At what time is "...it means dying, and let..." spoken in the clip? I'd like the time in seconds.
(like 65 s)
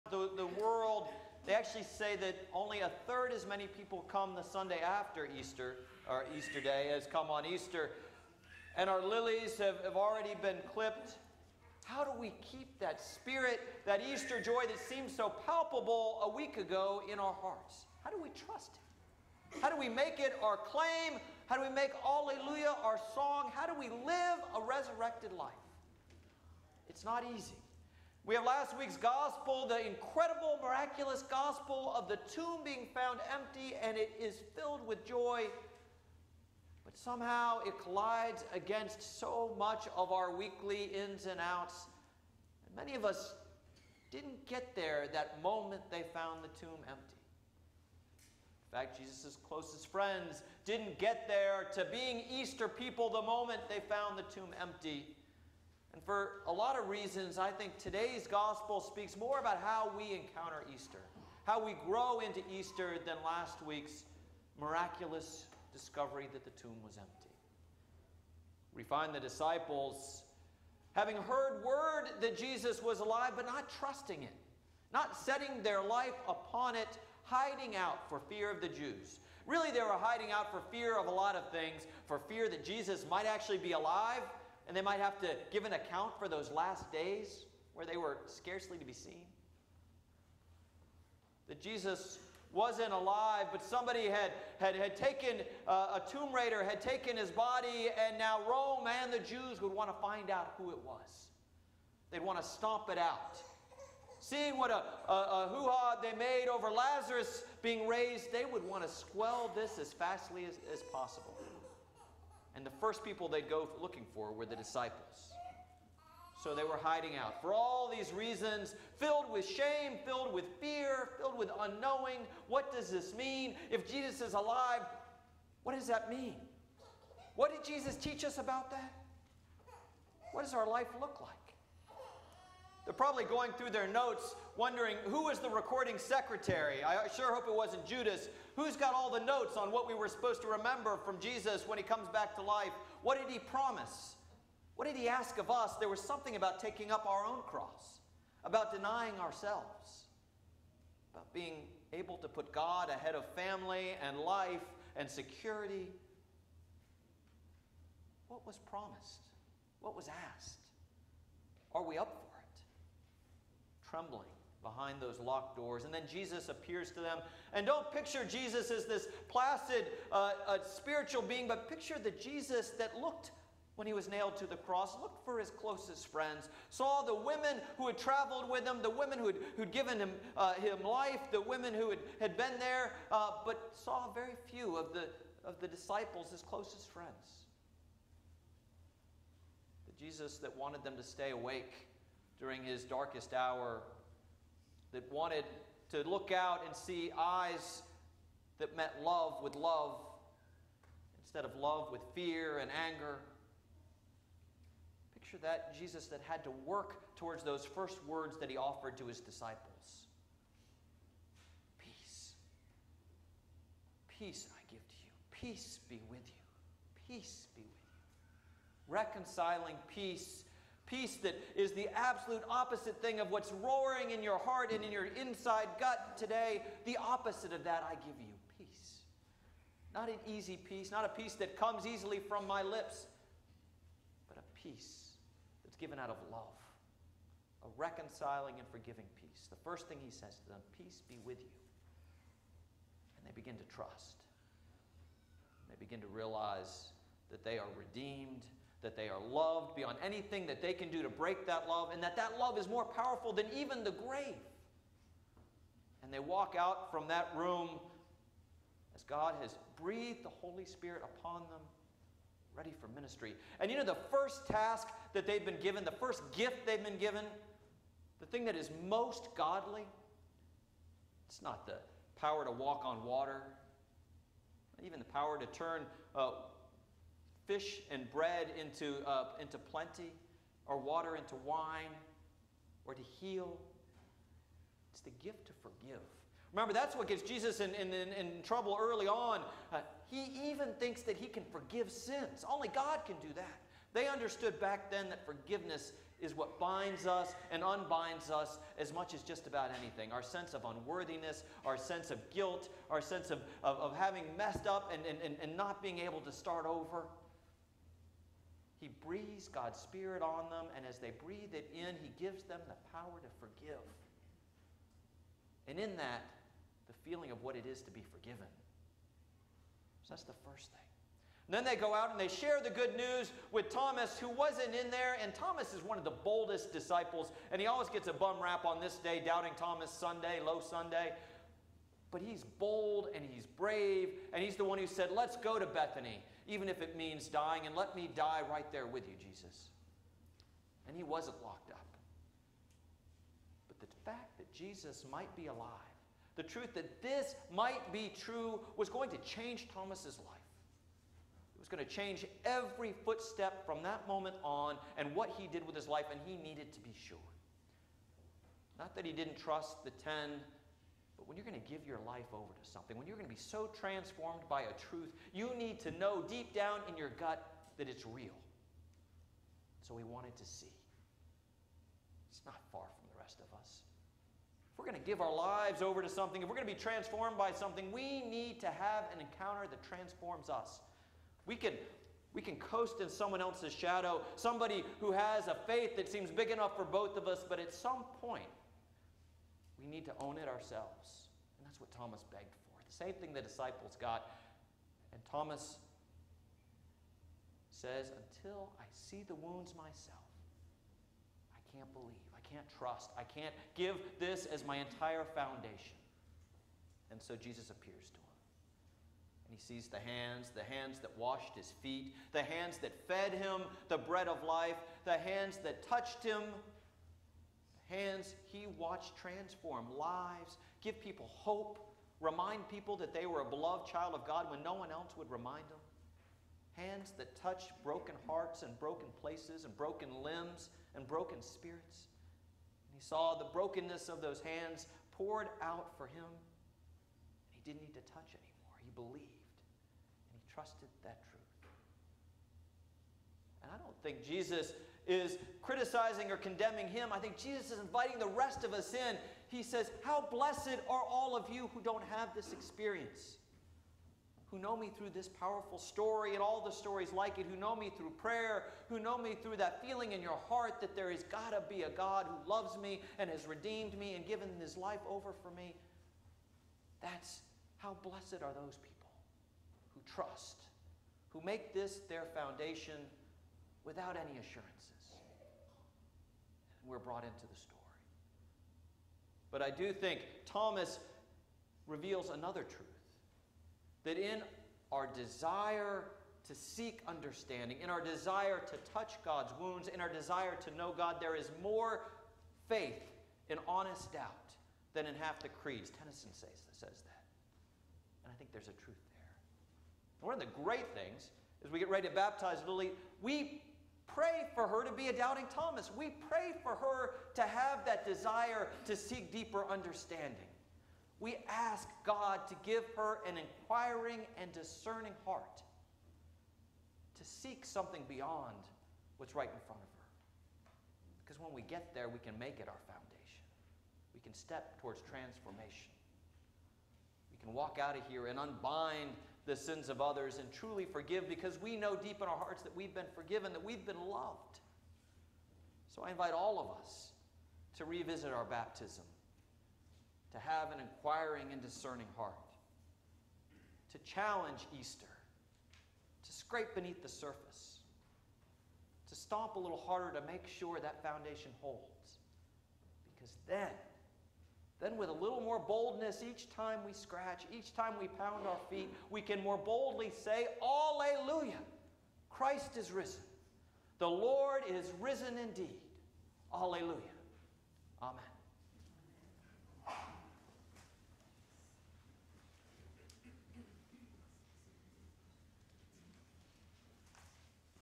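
336 s.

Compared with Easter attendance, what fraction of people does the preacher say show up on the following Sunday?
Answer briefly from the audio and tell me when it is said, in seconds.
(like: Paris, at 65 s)
a third, at 2 s.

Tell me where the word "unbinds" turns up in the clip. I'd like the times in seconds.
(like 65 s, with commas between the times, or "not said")
297 s, 528 s.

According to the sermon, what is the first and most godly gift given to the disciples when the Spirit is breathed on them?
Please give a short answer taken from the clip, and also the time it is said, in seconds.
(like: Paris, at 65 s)
the gift to forgive, at 285 s.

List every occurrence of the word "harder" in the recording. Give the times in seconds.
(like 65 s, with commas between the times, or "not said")
549 s.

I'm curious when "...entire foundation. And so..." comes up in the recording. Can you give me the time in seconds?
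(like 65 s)
404 s.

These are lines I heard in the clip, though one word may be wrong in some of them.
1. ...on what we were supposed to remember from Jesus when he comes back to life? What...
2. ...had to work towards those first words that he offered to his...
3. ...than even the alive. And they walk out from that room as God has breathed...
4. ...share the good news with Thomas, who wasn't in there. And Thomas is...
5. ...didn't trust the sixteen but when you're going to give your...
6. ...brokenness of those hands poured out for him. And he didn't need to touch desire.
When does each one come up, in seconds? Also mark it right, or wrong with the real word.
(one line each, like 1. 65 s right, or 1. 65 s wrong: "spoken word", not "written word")
1. 139 s right
2. 206 s right
3. 253 s wrong: "grave", not "alive"
4. 322 s right
5. 359 s wrong: "ten", not "sixteen"
6. 433 s wrong: "anymore", not "desire".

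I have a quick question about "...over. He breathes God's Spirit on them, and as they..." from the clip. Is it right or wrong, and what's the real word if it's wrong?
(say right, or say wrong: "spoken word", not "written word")
right.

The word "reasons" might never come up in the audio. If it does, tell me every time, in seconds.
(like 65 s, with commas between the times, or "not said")
56 s, 118 s.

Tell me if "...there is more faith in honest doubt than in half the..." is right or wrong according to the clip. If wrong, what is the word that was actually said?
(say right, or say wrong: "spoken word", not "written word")
right.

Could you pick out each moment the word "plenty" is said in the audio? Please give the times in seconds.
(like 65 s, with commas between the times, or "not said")
279 s.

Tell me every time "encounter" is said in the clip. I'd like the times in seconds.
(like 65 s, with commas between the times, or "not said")
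60 s, 379 s.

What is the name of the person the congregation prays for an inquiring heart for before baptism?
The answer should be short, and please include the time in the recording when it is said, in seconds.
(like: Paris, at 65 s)
Lily, at 502 s.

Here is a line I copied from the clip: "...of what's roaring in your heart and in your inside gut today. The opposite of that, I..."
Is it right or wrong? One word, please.
right.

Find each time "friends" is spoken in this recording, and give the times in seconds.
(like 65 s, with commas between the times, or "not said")
49 s, 176 s, 186 s.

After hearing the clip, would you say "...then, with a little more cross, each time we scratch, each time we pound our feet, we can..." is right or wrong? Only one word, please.
wrong.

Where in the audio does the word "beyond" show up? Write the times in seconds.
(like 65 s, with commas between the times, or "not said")
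249 s, 518 s.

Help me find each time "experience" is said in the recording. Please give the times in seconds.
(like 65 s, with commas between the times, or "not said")
452 s.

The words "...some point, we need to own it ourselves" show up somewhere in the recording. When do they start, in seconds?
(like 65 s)
387 s.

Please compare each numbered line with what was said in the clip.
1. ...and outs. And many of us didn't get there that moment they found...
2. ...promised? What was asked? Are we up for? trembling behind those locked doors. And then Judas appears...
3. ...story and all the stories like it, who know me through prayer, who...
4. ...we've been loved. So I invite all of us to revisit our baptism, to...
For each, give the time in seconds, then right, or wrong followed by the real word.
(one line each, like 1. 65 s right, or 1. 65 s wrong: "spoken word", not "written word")
1. 41 s right
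2. 158 s wrong: "Jesus", not "Judas"
3. 455 s right
4. 533 s right.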